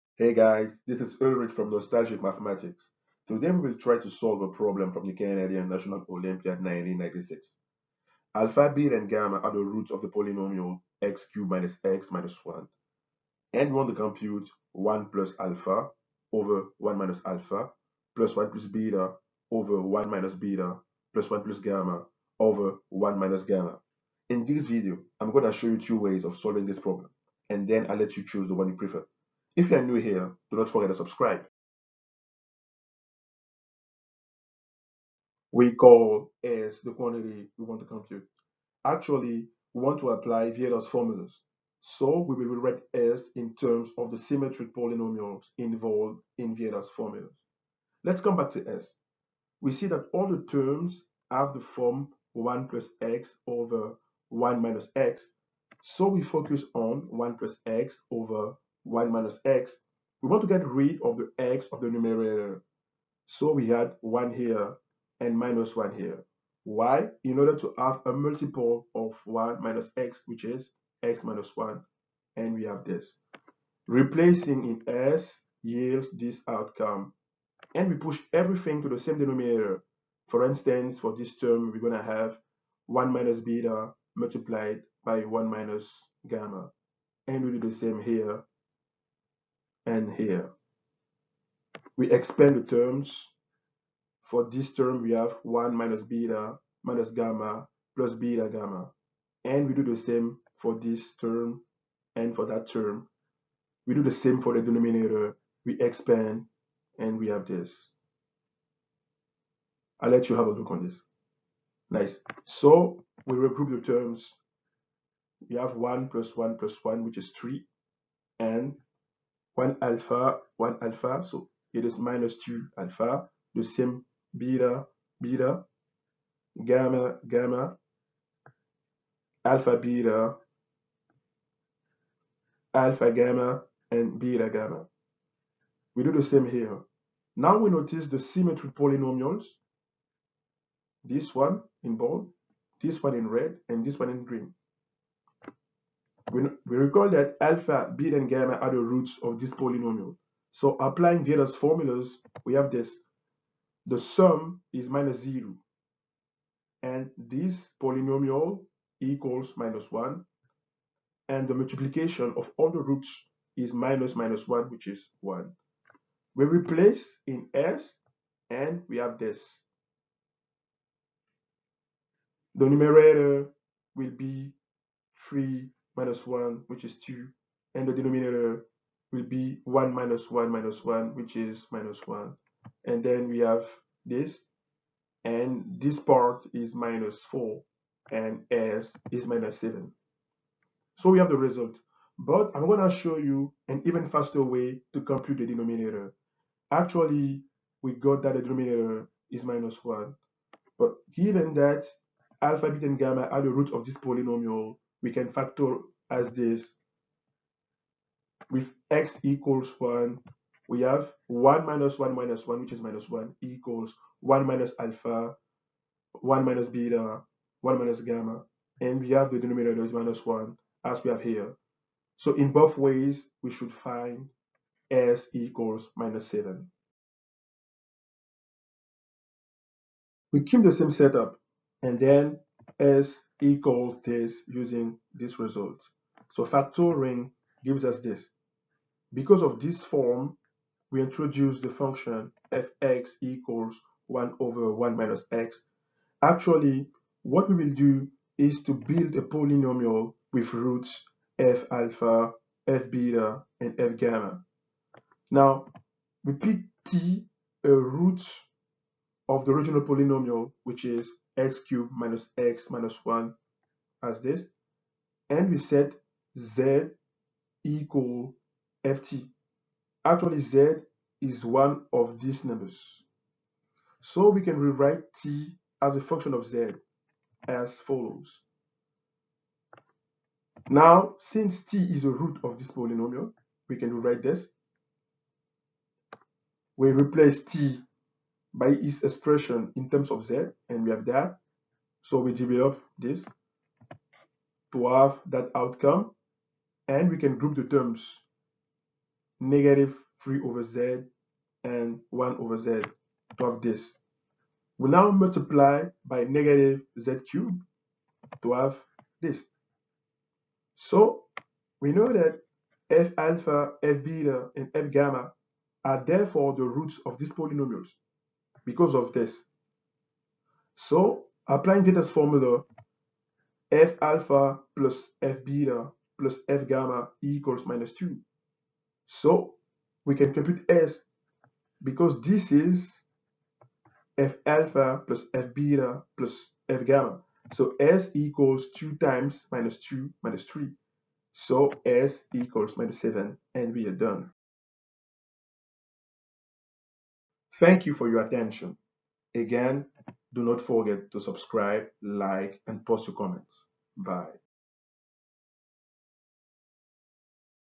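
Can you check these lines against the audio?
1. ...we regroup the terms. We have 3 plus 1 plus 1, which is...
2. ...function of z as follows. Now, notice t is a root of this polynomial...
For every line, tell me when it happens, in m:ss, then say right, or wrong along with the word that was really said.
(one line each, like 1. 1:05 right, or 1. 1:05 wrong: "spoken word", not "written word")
1. 1:53 wrong: "1", not "3"
2. 4:36 wrong: "since", not "notice".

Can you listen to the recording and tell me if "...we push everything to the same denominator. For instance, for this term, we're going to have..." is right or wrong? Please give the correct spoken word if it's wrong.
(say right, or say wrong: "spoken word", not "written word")
right.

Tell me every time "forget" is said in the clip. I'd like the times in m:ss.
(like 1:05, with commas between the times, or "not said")
0:30, 5:50.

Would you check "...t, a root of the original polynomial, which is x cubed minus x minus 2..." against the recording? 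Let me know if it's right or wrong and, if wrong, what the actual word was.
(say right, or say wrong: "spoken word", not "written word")
wrong: "1", not "2".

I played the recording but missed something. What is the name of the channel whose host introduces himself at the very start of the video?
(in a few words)
Nostalgic Mathematics.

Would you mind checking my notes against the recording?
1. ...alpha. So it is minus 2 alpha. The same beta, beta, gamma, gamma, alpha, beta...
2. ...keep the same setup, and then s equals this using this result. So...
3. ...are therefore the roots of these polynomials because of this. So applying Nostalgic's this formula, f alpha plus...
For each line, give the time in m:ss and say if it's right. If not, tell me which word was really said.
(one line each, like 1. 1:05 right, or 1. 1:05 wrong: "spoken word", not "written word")
1. 2:00 right
2. 3:50 right
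3. 5:15 wrong: "Vieta", not "Nostalgic".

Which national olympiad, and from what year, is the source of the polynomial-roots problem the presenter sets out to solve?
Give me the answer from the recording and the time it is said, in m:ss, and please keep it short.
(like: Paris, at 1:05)
Canadian National Olympiad 1996, at 0:05.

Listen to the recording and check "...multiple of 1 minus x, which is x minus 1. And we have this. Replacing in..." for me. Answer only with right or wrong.
right.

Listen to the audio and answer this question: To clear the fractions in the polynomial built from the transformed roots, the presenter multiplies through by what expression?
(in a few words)
negative z cubed.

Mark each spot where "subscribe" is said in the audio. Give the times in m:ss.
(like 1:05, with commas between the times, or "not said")
0:30, 5:51.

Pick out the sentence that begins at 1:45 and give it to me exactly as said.
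We expand and we have this.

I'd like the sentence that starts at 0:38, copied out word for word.
Actually, we want to apply Vieta's formulas.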